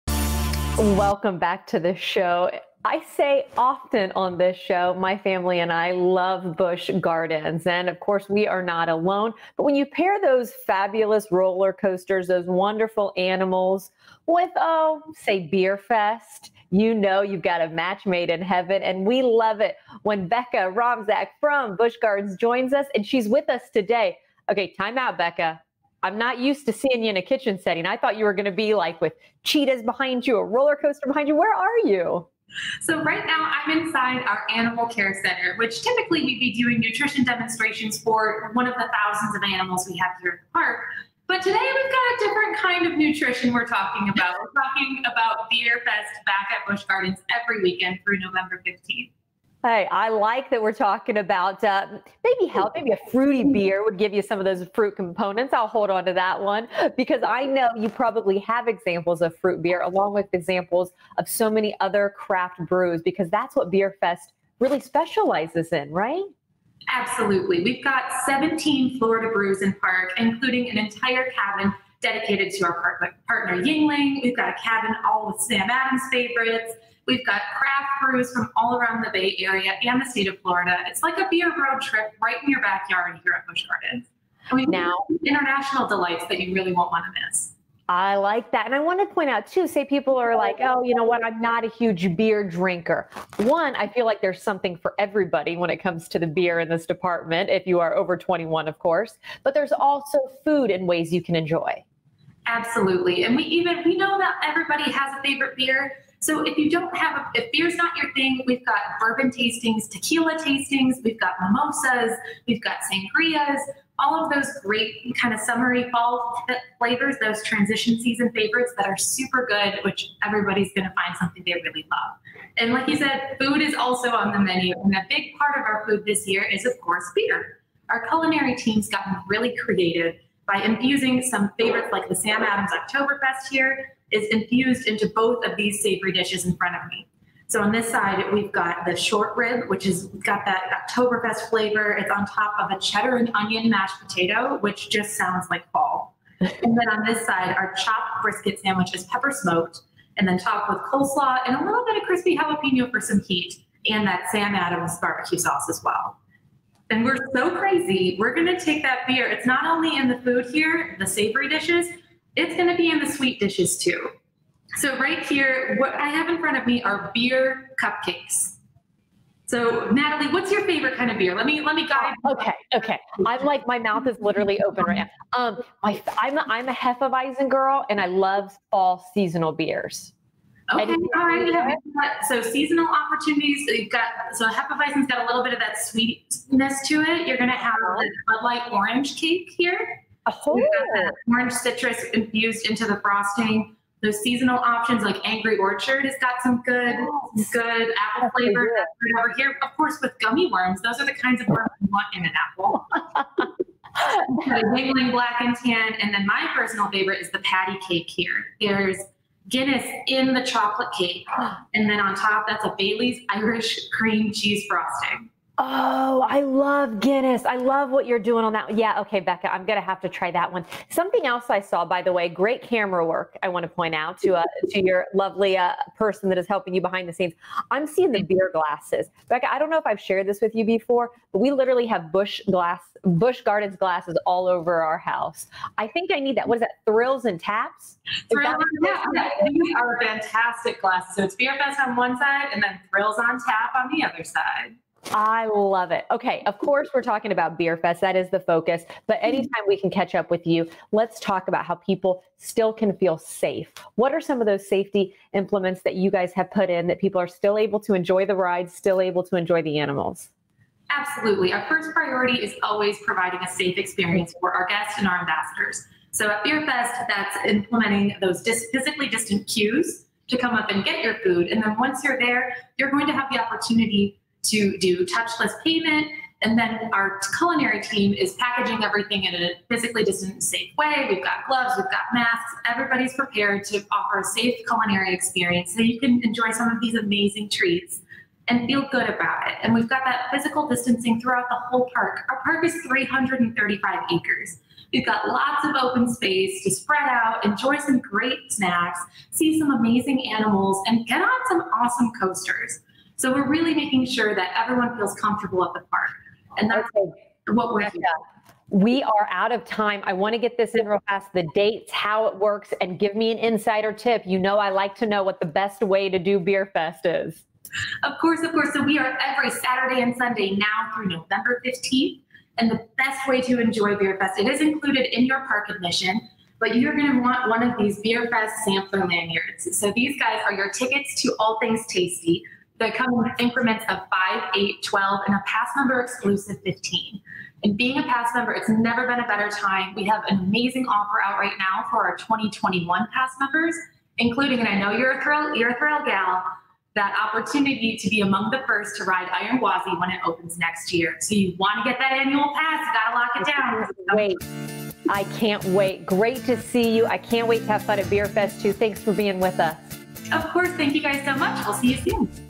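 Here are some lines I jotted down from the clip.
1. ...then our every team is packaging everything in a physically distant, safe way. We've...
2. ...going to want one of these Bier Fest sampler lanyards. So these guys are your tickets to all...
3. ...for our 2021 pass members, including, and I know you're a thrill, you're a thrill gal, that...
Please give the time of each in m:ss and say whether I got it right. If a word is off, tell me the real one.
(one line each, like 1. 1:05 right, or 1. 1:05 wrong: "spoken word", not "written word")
1. 4:36 wrong: "culinary", not "every"
2. 5:26 right
3. 5:41 right.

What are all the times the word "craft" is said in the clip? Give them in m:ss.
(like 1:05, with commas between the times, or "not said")
1:02, 1:17.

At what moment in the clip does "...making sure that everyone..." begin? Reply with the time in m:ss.
5:03.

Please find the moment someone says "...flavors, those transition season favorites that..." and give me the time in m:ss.
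1:56.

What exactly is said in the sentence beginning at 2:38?
We're going to take that beer.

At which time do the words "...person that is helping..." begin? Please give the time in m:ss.
3:45.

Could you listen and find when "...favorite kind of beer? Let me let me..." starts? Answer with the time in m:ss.
2:50.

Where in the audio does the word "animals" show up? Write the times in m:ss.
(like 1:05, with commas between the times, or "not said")
0:13, 0:34, 0:39, 4:19, 5:00.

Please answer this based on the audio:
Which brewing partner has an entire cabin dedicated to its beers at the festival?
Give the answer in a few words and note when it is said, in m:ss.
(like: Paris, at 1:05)
Yuengling, at 1:13.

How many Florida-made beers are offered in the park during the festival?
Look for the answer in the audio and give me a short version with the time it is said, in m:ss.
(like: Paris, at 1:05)
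17, at 1:08.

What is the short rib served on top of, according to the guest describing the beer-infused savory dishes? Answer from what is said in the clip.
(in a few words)
cheddar and onion mashed potato.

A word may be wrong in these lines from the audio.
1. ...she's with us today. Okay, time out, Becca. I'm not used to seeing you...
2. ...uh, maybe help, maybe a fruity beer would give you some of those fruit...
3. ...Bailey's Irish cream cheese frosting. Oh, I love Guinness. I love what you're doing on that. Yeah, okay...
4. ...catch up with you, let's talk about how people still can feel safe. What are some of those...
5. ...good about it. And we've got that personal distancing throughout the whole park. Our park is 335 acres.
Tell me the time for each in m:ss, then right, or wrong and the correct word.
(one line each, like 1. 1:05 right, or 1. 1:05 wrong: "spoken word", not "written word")
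1. 0:23 right
2. 0:51 right
3. 3:32 right
4. 4:09 right
5. 4:48 wrong: "physical", not "personal".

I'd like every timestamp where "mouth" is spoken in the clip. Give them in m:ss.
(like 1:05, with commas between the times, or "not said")
2:53.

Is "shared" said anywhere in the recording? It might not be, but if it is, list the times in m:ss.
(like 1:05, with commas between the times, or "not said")
3:49.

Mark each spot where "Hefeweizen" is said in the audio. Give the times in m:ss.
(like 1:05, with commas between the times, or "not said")
2:56, 3:04.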